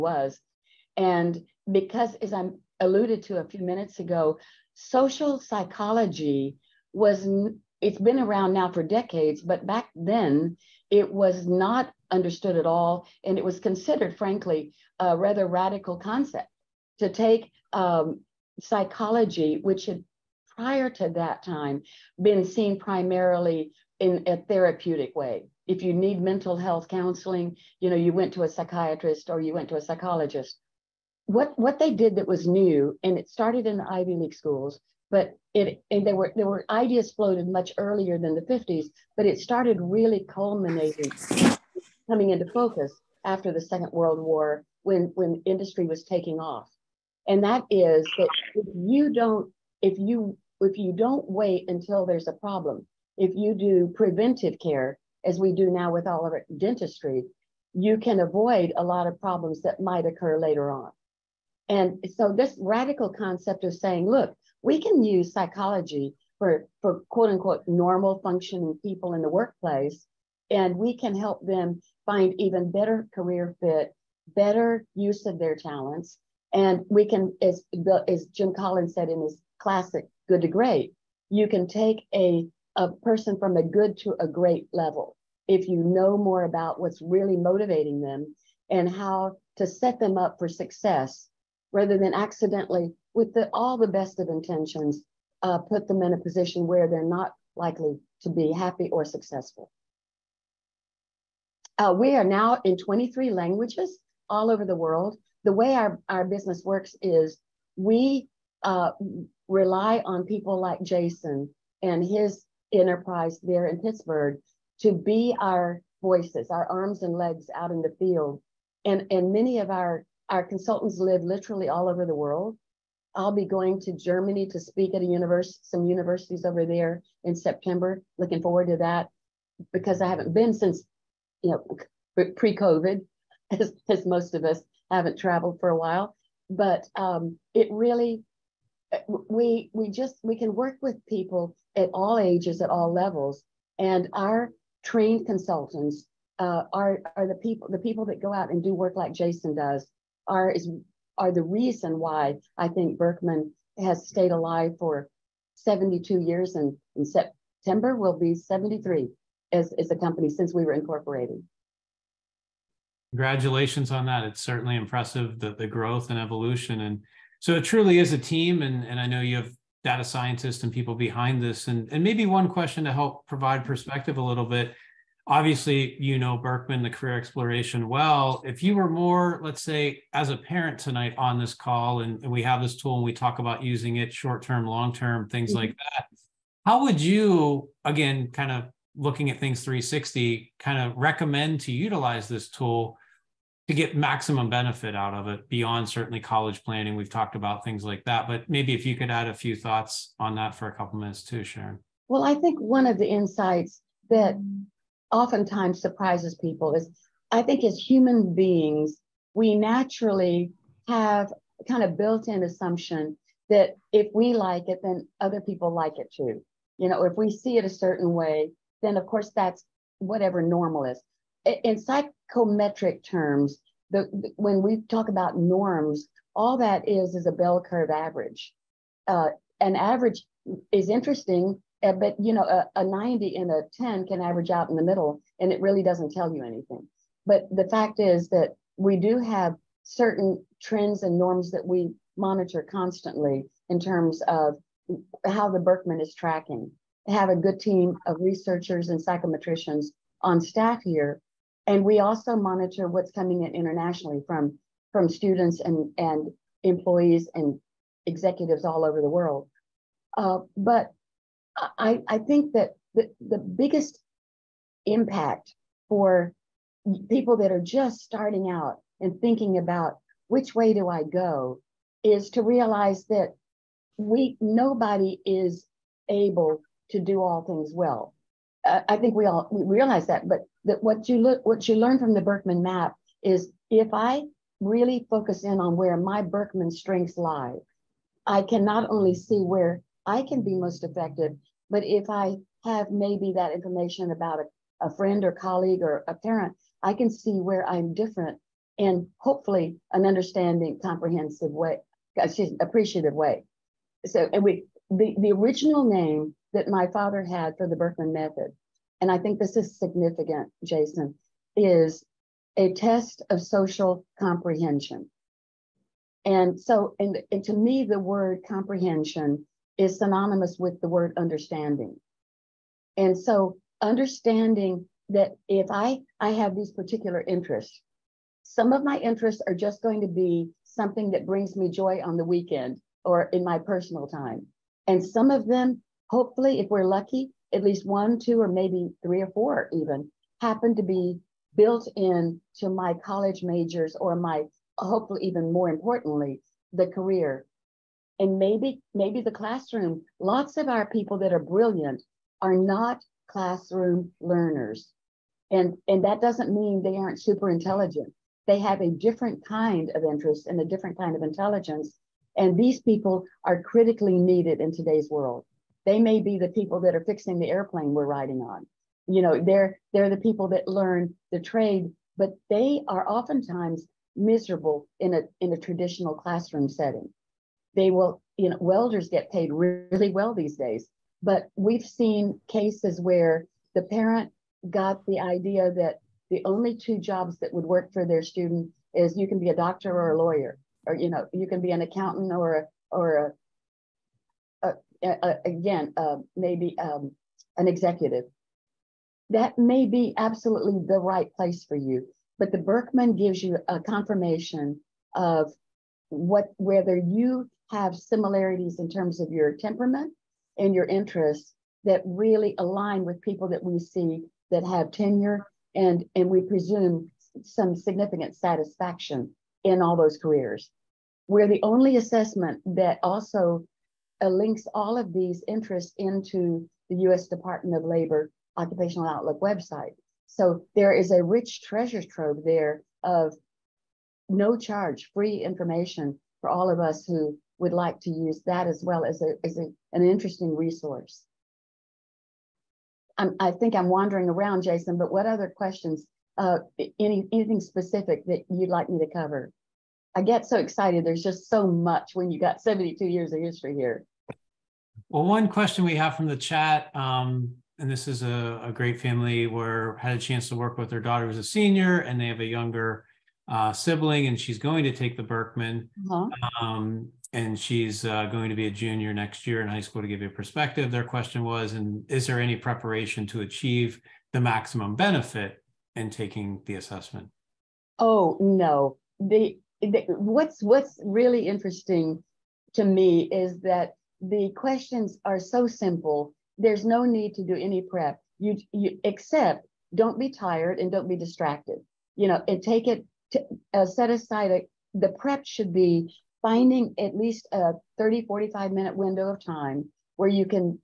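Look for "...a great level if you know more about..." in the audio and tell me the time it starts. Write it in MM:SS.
01:24.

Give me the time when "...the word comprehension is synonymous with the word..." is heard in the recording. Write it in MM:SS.
05:17.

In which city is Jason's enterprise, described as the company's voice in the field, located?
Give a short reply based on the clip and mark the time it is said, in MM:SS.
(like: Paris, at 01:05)
Pittsburgh, at 01:53.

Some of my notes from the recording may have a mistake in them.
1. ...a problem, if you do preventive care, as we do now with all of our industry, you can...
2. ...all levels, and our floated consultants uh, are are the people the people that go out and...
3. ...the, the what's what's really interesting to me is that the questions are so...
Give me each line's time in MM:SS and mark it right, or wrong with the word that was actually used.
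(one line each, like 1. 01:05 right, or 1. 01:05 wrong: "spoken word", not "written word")
1. 00:52 wrong: "dentistry", not "industry"
2. 02:22 wrong: "trained", not "floated"
3. 07:59 right.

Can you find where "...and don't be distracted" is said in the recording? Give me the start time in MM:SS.
08:10.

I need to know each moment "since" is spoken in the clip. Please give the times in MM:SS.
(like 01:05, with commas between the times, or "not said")
02:10, 02:40.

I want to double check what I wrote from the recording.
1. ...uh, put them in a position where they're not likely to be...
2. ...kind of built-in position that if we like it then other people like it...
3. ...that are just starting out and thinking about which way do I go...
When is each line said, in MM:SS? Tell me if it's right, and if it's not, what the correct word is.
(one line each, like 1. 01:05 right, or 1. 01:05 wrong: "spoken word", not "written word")
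1. 01:35 right
2. 03:31 wrong: "assumption", not "position"
3. 04:27 right.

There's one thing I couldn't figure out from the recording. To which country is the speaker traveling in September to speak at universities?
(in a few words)
Germany.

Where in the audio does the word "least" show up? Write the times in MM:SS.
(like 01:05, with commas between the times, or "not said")
05:37, 08:17.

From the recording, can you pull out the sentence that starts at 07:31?
There's just so much when you got 72 years of history here.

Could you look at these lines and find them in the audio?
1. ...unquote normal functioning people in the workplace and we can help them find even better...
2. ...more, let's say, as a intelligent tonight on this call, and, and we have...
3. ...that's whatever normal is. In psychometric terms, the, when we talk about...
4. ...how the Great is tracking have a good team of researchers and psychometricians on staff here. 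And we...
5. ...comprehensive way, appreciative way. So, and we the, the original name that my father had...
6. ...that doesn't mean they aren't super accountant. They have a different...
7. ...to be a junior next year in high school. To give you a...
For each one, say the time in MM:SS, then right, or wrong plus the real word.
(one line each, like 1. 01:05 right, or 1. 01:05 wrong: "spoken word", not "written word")
1. 01:07 right
2. 02:58 wrong: "parent", not "intelligent"
3. 03:39 right
4. 04:05 wrong: "Birkman", not "Great"
5. 05:00 right
6. 05:56 wrong: "intelligent", not "accountant"
7. 07:48 right.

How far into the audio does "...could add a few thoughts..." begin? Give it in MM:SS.
03:18.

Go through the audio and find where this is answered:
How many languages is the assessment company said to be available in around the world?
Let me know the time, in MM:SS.
01:42.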